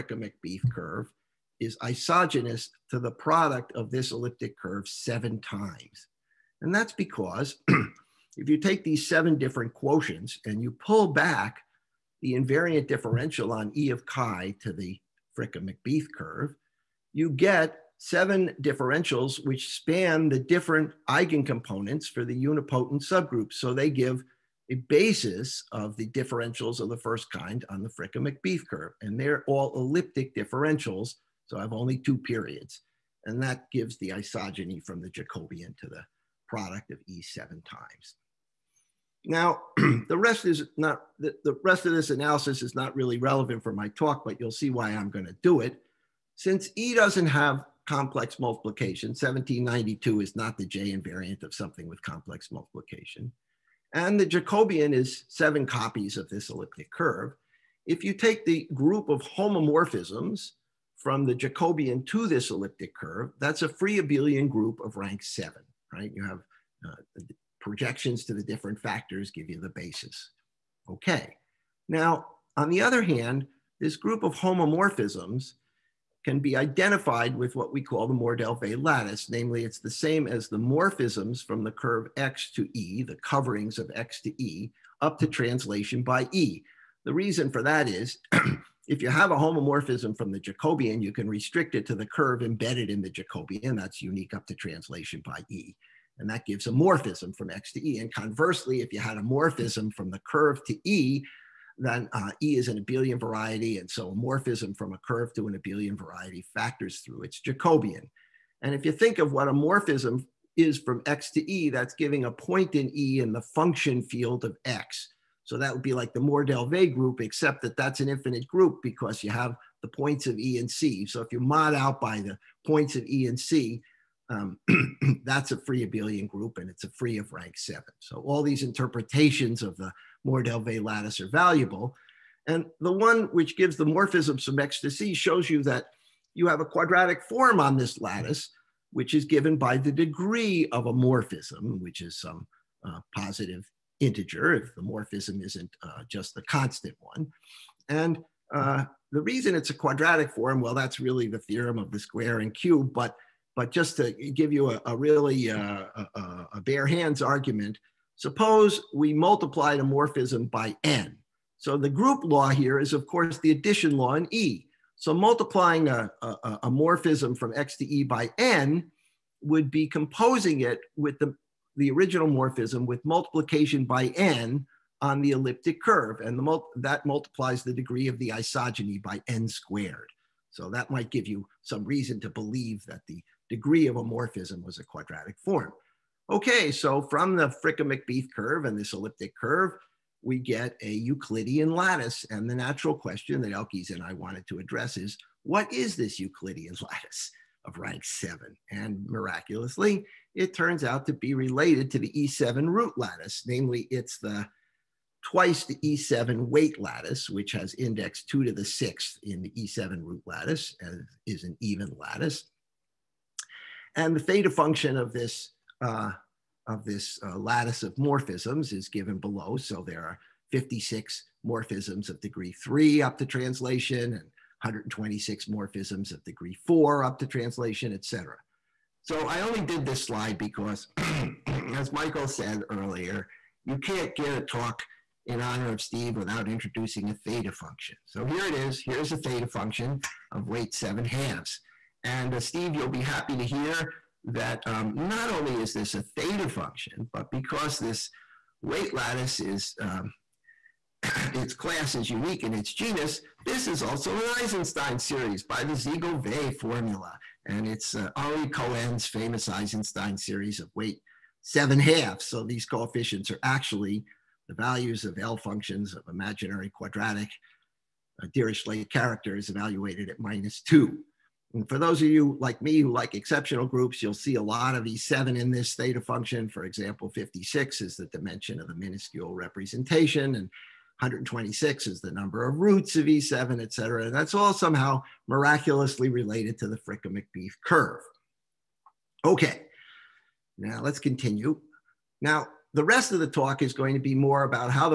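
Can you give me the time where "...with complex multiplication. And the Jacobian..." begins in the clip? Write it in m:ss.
0:51.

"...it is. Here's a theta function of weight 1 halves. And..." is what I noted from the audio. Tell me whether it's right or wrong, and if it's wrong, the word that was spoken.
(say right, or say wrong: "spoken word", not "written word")
wrong: "7", not "1".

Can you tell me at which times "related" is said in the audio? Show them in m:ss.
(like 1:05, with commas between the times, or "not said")
3:21, 4:46.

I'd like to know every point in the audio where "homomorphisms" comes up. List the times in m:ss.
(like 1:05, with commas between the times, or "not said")
0:59, 1:14, 1:29.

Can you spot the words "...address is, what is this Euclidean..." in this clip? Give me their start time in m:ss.
3:14.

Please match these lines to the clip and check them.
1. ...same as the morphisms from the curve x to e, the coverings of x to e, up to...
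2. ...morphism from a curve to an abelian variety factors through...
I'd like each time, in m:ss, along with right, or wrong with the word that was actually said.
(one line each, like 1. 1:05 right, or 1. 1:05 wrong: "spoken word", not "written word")
1. 1:19 right
2. 1:44 right.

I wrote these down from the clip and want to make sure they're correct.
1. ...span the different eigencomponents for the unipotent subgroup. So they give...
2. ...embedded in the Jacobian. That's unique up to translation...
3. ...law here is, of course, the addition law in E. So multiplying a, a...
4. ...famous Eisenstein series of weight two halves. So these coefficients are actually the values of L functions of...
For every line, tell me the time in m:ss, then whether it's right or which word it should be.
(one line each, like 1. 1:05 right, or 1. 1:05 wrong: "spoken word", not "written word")
1. 0:19 right
2. 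1:32 right
3. 2:42 right
4. 4:19 wrong: "seven", not "two".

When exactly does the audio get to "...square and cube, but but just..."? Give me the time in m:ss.
2:31.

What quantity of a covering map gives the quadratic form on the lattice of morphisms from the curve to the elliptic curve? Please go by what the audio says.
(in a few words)
degree of a morphism.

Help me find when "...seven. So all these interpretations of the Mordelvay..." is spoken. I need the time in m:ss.
2:07.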